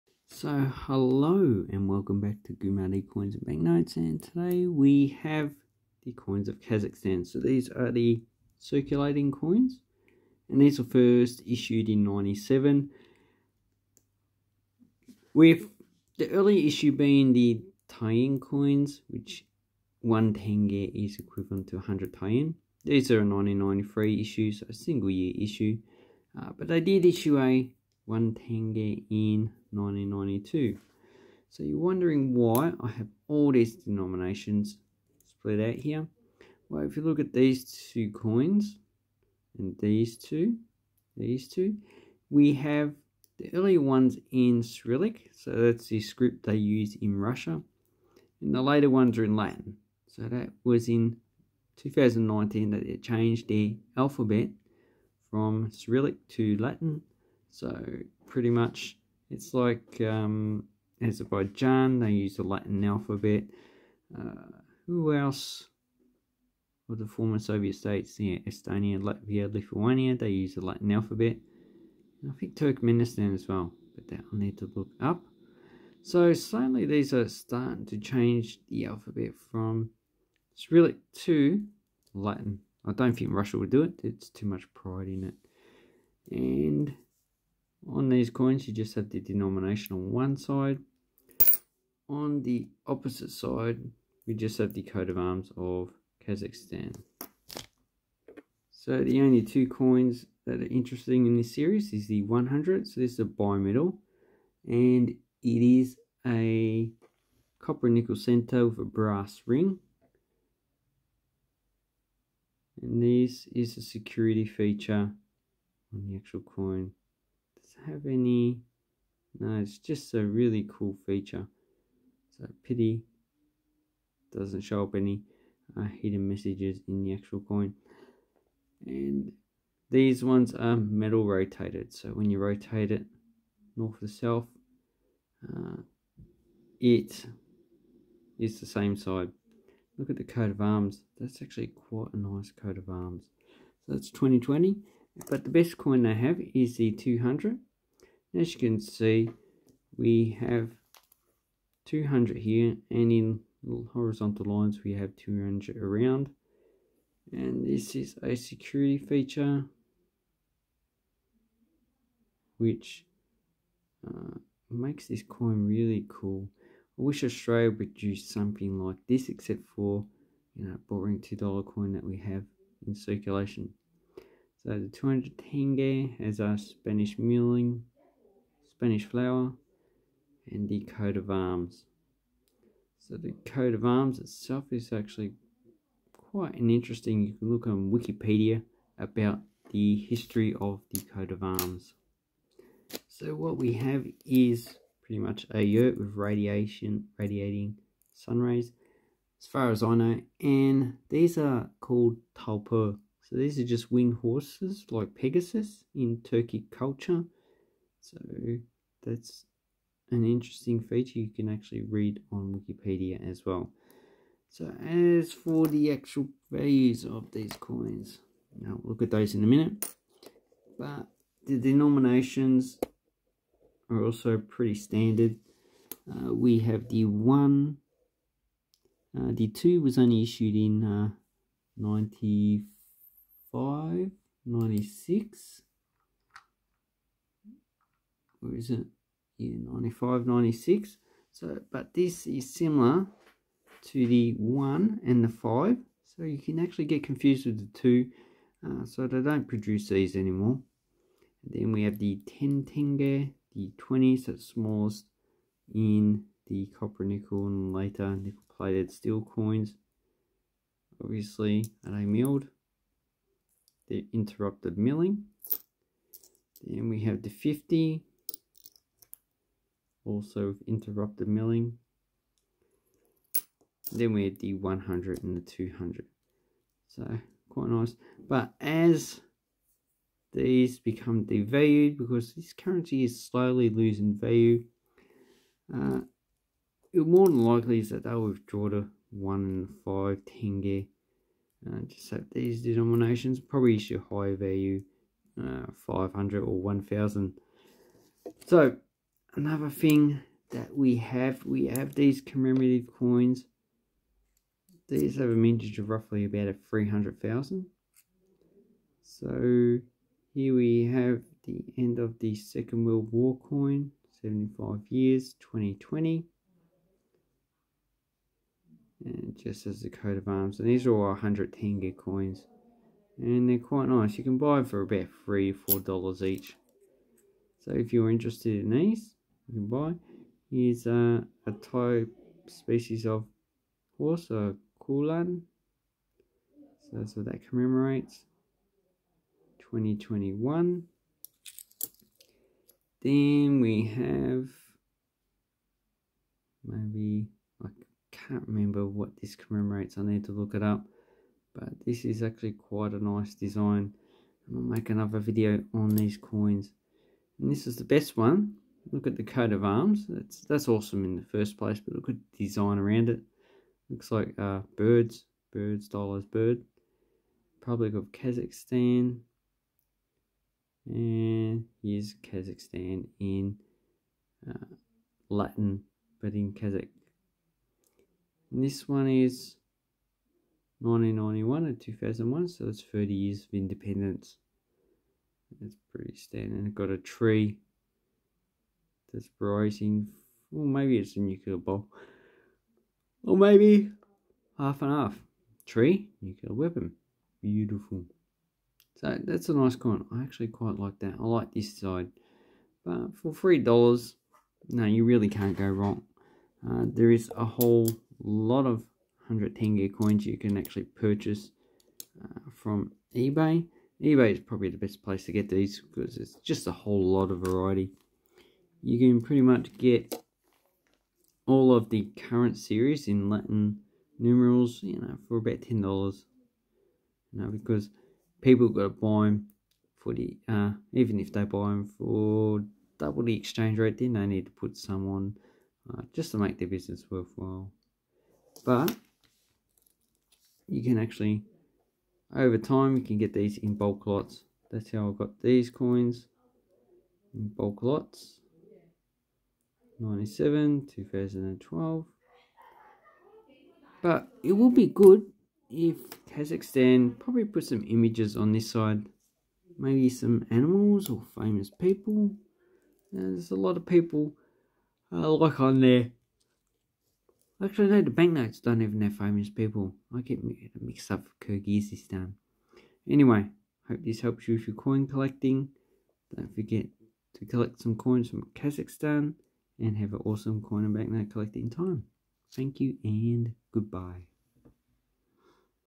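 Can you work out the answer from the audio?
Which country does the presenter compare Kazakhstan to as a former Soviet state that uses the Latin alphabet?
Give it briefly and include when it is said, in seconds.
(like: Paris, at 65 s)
Azerbaijan, at 61 s.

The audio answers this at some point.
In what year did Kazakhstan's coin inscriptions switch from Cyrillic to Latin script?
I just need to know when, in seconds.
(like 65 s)
51 s.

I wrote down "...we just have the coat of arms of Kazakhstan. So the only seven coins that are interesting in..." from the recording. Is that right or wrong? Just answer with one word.
wrong.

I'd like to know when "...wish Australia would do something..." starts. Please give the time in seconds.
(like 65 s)
167 s.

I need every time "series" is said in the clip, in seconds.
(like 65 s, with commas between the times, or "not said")
101 s, 422 s.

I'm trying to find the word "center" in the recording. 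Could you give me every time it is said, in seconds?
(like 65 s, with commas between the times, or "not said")
108 s.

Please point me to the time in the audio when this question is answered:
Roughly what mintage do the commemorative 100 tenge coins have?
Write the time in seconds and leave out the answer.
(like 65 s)
306 s.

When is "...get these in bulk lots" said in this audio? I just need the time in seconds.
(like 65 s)
443 s.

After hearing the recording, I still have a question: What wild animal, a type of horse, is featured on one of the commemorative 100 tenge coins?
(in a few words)
Kulan.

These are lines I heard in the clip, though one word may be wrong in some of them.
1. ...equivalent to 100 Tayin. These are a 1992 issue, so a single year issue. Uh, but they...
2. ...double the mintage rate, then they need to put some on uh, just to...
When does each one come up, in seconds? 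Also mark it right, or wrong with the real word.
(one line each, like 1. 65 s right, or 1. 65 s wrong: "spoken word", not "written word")
1. 21 s wrong: "1993", not "1992"
2. 432 s wrong: "exchange", not "mintage".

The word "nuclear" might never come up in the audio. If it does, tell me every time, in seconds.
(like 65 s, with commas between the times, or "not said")
391 s, 396 s.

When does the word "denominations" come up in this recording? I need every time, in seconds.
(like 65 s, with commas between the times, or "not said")
33 s, 89 s, 221 s, 292 s.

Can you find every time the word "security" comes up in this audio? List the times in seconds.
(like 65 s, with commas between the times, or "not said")
113 s, 158 s.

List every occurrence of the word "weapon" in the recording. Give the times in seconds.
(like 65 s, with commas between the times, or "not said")
396 s.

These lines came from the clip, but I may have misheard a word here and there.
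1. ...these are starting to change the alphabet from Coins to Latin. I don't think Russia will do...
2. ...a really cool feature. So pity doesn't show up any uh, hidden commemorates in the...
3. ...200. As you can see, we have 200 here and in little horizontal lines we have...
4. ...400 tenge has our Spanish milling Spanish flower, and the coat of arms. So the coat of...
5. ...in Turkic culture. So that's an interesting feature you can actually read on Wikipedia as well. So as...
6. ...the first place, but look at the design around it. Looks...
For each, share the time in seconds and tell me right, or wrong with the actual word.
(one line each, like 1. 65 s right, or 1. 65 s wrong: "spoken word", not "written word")
1. 76 s wrong: "Cyrillic", not "Coins"
2. 120 s wrong: "messages", not "commemorates"
3. 146 s right
4. 174 s wrong: "200", not "400"
5. 205 s right
6. 361 s right.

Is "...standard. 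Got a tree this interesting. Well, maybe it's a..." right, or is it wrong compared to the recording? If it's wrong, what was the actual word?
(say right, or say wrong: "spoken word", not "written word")
wrong: "rising", not "interesting".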